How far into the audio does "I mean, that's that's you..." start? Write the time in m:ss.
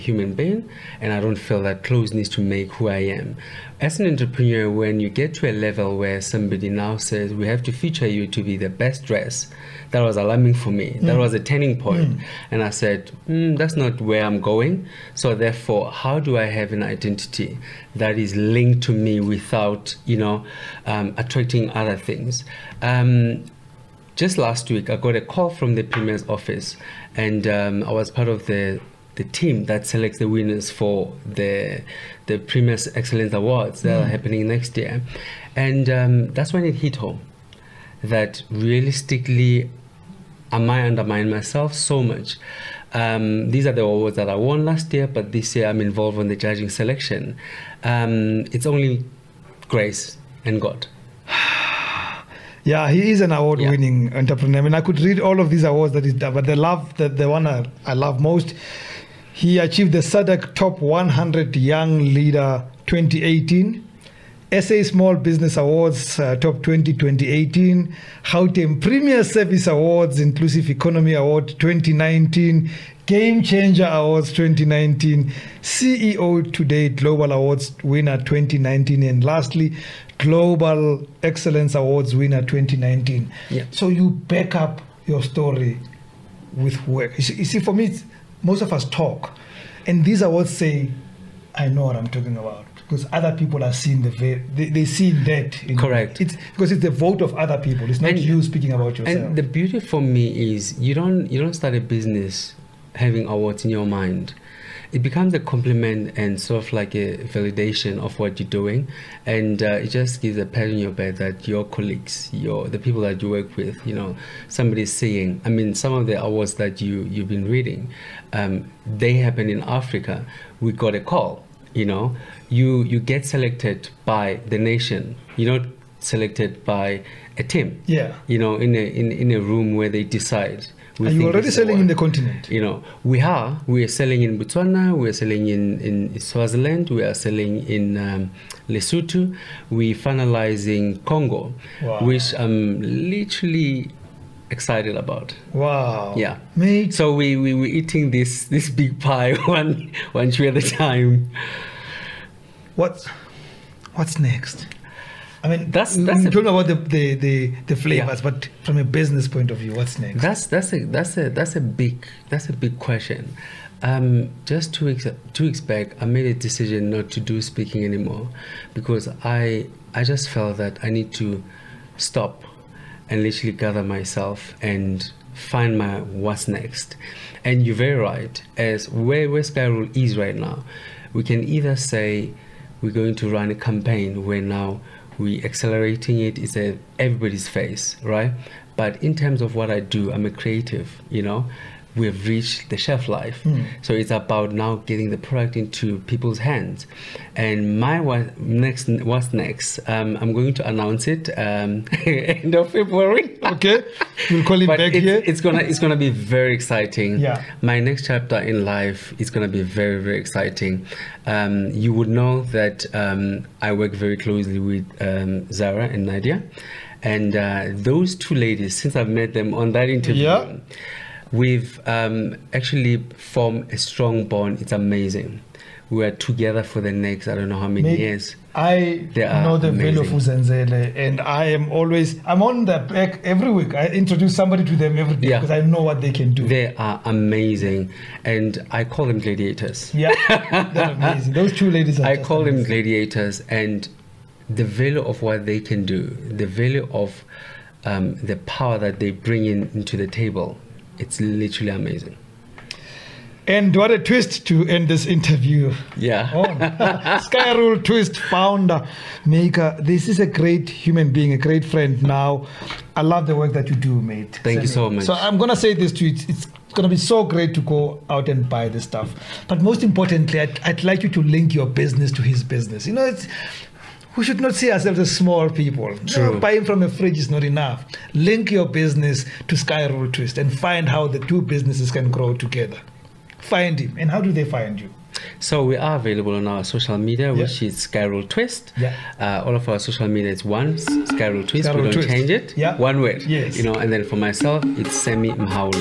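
2:35.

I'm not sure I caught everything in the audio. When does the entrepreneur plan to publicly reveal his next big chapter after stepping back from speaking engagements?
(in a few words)
End of February.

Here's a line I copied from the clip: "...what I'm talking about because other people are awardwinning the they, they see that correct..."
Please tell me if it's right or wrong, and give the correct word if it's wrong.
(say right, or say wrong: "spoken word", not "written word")
wrong: "seeing", not "awardwinning".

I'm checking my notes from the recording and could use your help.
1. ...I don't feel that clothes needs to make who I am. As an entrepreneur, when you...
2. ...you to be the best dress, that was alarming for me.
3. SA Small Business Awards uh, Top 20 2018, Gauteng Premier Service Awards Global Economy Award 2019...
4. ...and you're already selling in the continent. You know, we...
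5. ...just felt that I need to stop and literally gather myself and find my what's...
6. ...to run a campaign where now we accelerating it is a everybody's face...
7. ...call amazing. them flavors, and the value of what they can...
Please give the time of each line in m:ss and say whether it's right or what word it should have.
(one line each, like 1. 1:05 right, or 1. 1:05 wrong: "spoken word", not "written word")
1. 0:01 right
2. 0:08 right
3. 1:04 wrong: "Inclusive", not "Global"
4. 2:11 right
5. 2:50 right
6. 3:03 right
7. 4:02 wrong: "gladiators", not "flavors".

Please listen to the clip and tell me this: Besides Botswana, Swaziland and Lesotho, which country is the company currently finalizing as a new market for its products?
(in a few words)
Congo.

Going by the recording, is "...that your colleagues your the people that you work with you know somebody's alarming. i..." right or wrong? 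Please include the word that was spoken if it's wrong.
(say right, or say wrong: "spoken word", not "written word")
wrong: "seeing", not "alarming".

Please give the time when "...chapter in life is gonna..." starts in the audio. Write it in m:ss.
3:28.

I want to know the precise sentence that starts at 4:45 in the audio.
So we are available on our social media, yeah.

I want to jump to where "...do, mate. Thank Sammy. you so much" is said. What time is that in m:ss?
4:23.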